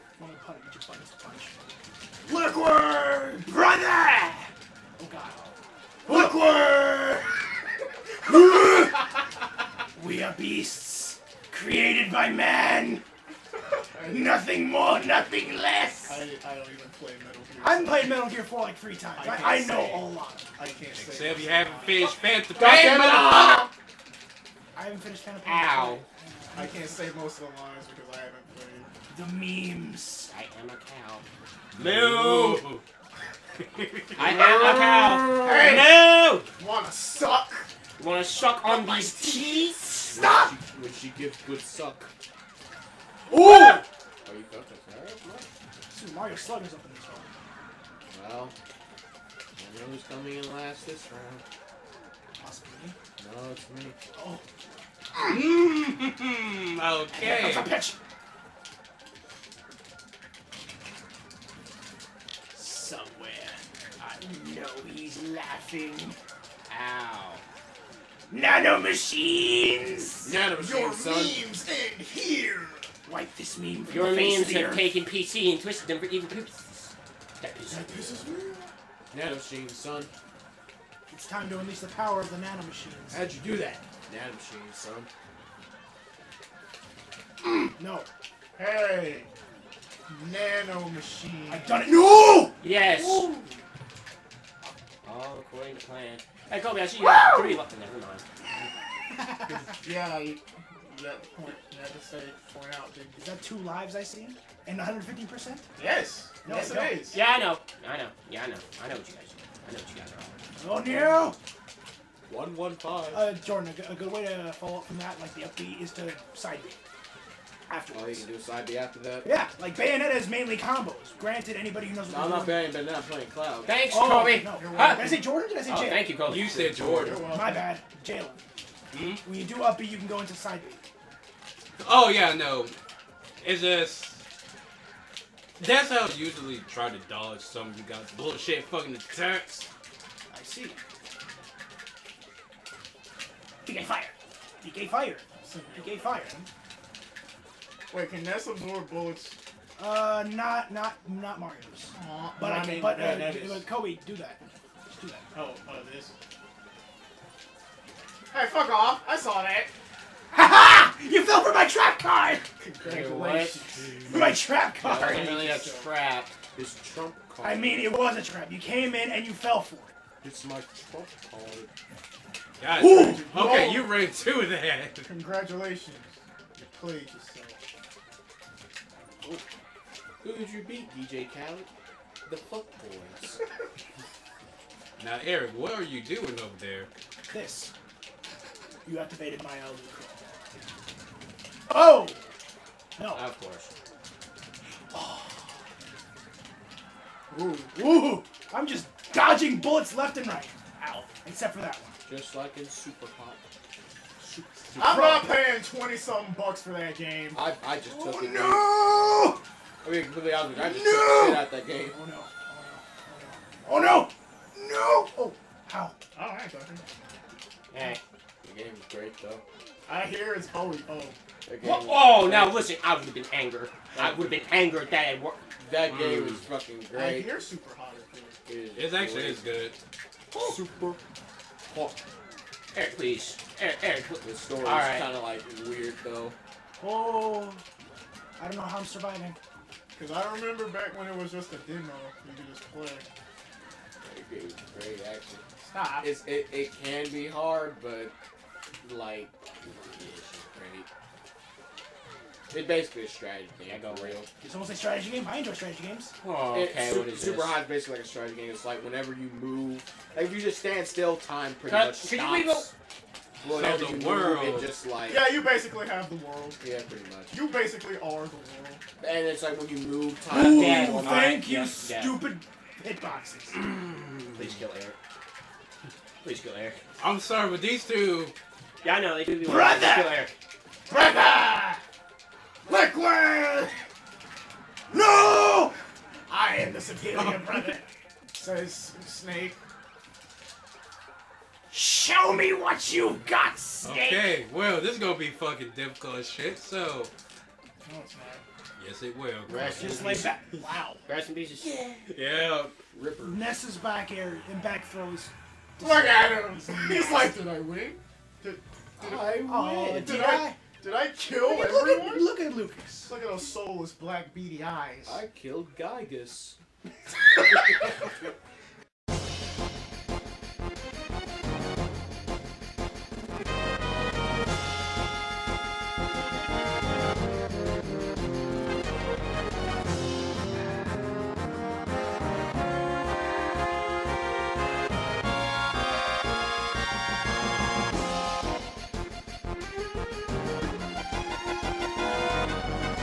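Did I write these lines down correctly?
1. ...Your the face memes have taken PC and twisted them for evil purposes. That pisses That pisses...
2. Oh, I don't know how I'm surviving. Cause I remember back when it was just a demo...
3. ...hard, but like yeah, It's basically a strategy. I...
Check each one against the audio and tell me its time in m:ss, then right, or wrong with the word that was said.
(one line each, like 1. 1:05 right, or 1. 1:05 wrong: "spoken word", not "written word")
1. 1:13 right
2. 3:56 right
3. 4:07 right.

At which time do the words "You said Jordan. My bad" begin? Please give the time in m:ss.
2:06.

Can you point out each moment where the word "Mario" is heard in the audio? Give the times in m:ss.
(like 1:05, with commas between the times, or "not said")
0:46, 2:31.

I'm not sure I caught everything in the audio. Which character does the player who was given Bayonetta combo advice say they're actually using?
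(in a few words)
Cloud.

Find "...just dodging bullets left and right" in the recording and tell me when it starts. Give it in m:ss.
3:18.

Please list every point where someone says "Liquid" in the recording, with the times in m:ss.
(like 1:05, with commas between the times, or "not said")
0:02, 0:08, 4:42.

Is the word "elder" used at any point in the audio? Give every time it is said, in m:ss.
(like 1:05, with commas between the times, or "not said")
3:09.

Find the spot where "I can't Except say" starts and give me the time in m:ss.
0:20.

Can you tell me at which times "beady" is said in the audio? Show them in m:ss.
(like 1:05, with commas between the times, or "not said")
5:14.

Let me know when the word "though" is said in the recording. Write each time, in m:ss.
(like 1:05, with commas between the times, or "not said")
3:39, 3:56.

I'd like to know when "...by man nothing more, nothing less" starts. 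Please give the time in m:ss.
0:12.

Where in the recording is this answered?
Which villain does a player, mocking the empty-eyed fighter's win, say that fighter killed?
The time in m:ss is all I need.
5:15.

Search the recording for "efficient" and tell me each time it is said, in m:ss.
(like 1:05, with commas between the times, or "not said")
not said.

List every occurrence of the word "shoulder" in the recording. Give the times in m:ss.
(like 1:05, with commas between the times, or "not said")
not said.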